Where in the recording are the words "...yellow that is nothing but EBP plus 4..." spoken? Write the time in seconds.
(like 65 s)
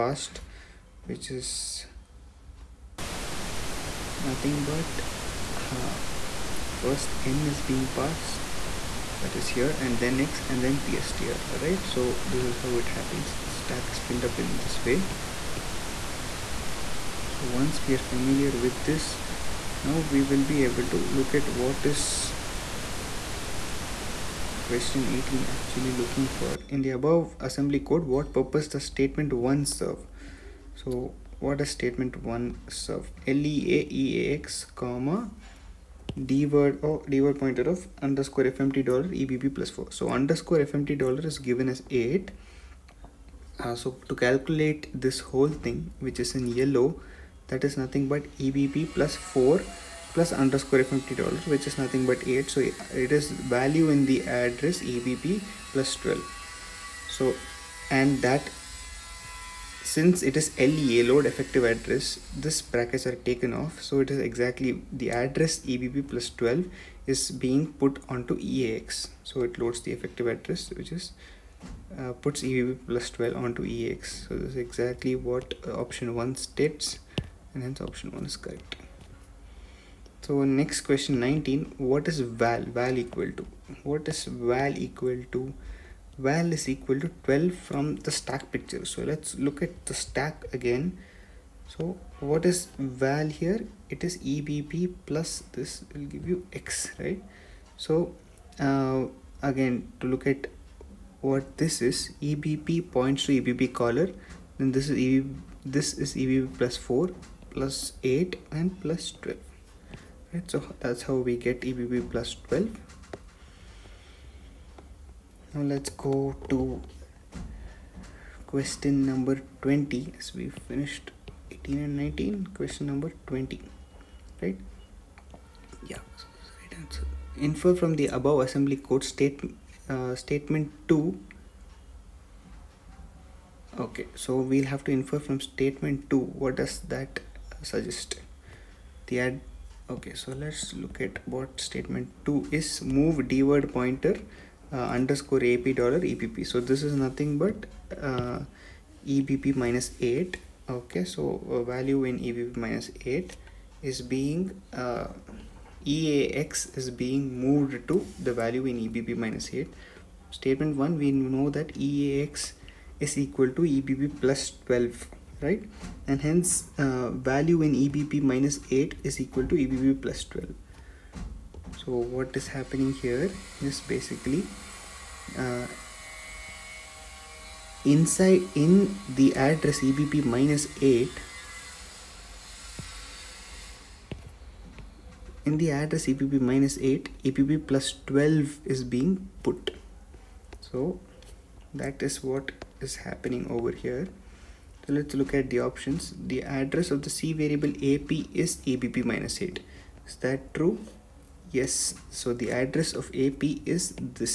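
46 s.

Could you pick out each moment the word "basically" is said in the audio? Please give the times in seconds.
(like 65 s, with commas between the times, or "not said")
173 s.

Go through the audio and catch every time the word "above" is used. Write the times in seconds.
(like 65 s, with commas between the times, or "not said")
27 s, 128 s.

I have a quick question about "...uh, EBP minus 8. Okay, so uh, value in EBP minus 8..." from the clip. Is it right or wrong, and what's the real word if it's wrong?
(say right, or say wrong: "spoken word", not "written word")
right.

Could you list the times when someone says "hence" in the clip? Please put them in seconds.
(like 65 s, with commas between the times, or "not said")
77 s, 166 s.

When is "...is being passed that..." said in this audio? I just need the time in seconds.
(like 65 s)
7 s.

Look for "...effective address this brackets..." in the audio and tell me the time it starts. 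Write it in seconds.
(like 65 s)
61 s.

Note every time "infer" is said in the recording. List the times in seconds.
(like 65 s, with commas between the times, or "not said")
127 s, 134 s.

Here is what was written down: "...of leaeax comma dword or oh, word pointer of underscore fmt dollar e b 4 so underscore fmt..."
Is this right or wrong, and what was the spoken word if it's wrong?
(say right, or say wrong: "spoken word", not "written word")
right.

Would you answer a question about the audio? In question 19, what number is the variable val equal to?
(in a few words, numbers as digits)
12.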